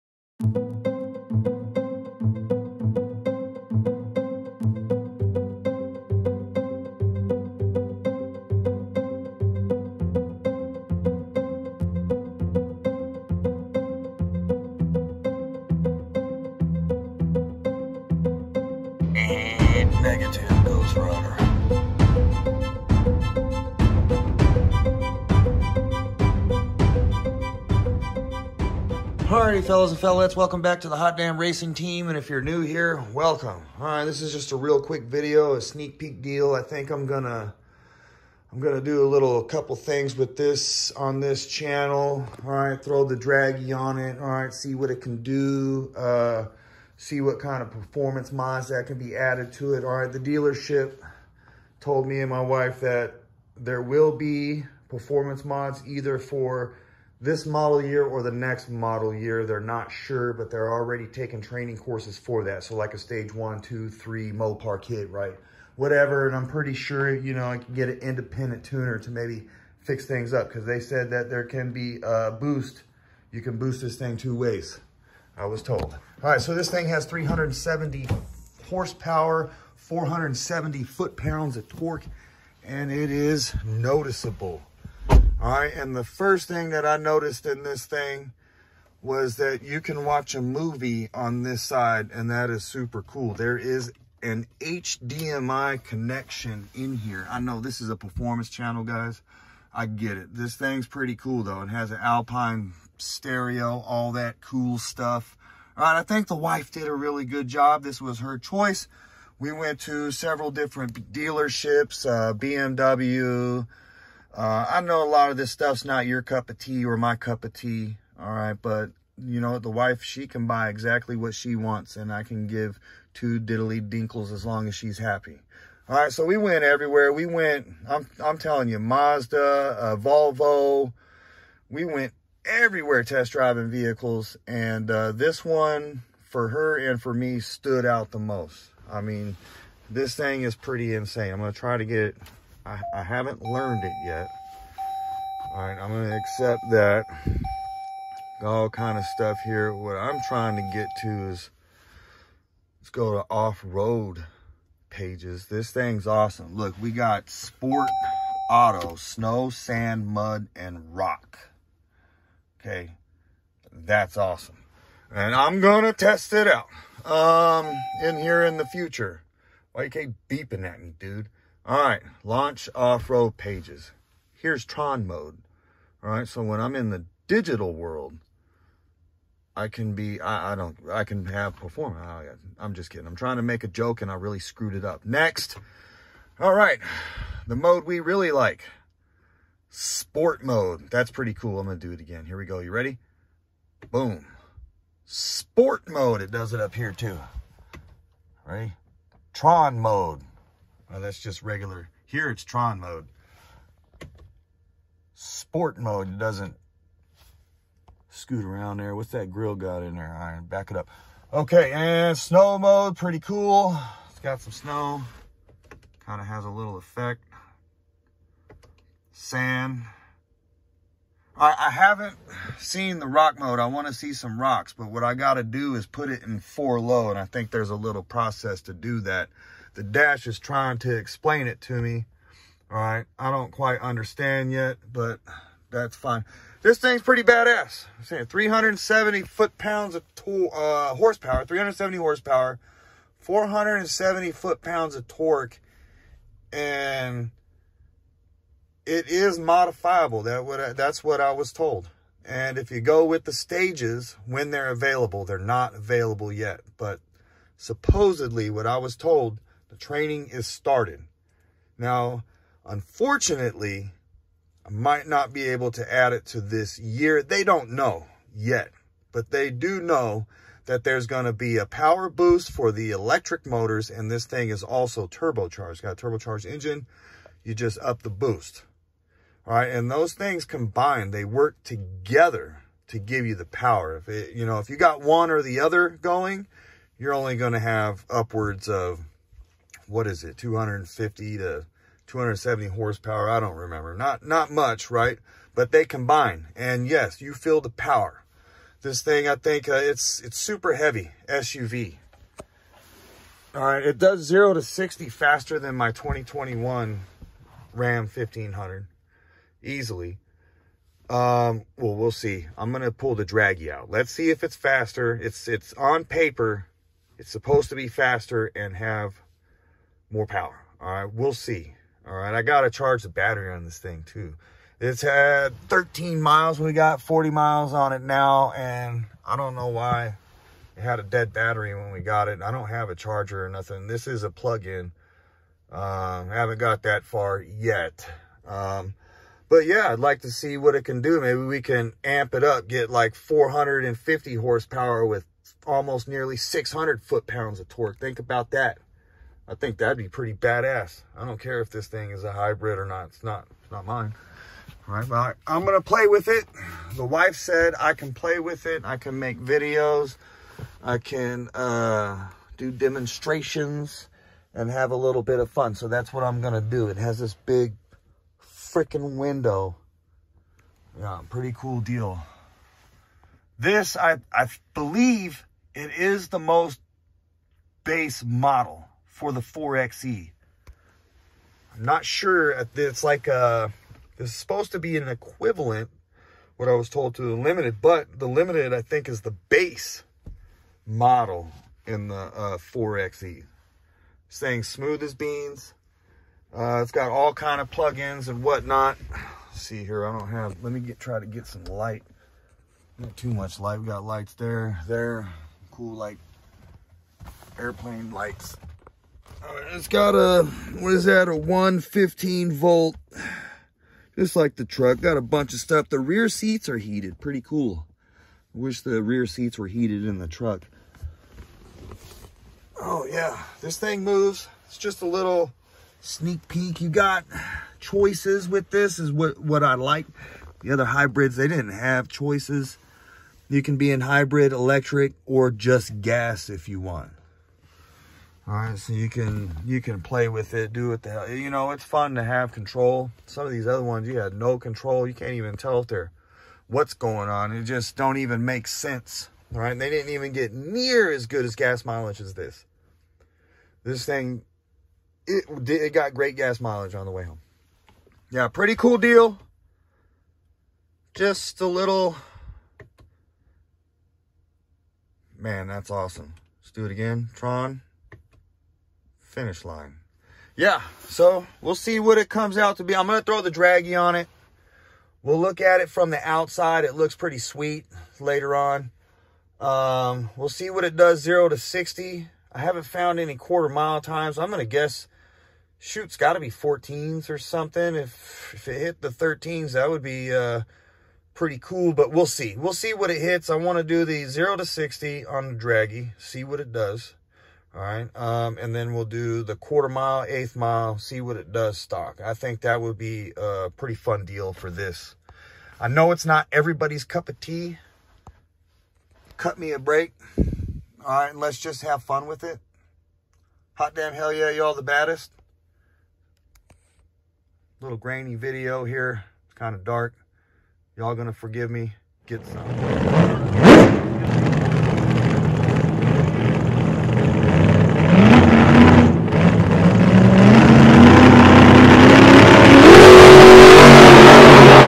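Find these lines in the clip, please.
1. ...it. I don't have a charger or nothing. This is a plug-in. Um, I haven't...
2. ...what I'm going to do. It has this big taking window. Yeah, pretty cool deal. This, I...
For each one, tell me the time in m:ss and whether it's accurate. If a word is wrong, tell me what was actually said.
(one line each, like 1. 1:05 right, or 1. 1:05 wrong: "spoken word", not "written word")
1. 5:32 right
2. 6:06 wrong: "freaking", not "taking".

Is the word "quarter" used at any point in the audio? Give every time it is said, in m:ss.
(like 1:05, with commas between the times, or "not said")
8:03, 8:19.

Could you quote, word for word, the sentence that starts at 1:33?
There is an HDMI connection in here.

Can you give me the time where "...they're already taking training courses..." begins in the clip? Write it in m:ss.
1:00.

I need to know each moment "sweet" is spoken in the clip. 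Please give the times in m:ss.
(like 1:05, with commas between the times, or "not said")
7:57.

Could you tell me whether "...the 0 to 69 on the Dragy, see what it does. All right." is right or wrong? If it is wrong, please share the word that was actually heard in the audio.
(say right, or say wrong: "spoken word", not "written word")
wrong: "60", not "69".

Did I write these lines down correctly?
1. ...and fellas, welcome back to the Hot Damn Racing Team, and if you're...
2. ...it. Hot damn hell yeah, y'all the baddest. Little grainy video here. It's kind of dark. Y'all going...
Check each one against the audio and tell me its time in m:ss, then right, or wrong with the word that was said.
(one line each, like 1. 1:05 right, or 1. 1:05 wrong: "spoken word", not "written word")
1. 0:29 right
2. 8:32 right.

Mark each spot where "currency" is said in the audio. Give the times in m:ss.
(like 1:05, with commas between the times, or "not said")
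not said.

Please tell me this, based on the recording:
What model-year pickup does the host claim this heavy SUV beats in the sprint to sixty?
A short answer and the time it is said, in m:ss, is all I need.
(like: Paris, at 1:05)
2021 Ram 1500, at 5:05.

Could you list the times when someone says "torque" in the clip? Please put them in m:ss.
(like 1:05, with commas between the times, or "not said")
1:21, 4:05, 5:47.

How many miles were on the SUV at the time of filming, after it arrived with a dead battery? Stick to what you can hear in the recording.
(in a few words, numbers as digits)
40.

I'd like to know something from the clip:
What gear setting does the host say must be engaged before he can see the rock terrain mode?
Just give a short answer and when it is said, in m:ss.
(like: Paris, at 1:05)
four low, at 3:46.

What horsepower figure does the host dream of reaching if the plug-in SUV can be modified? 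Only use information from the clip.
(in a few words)
450.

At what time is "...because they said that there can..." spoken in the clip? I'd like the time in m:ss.
1:10.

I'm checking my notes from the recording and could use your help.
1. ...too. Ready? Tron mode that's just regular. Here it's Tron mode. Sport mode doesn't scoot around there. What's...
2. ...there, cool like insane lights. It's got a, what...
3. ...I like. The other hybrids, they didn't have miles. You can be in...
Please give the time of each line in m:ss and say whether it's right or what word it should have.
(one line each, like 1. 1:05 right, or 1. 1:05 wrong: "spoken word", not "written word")
1. 3:16 right
2. 6:44 wrong: "airplane", not "insane"
3. 7:09 wrong: "choices", not "miles".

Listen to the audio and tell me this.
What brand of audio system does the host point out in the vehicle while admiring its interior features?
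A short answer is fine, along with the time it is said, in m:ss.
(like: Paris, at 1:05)
Alpine, at 1:42.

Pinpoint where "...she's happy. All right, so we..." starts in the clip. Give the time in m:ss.
2:04.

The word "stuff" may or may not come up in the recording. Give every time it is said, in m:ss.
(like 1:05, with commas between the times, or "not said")
1:44, 1:55, 2:29, 6:55.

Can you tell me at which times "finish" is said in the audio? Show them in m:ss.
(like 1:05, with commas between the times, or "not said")
7:49.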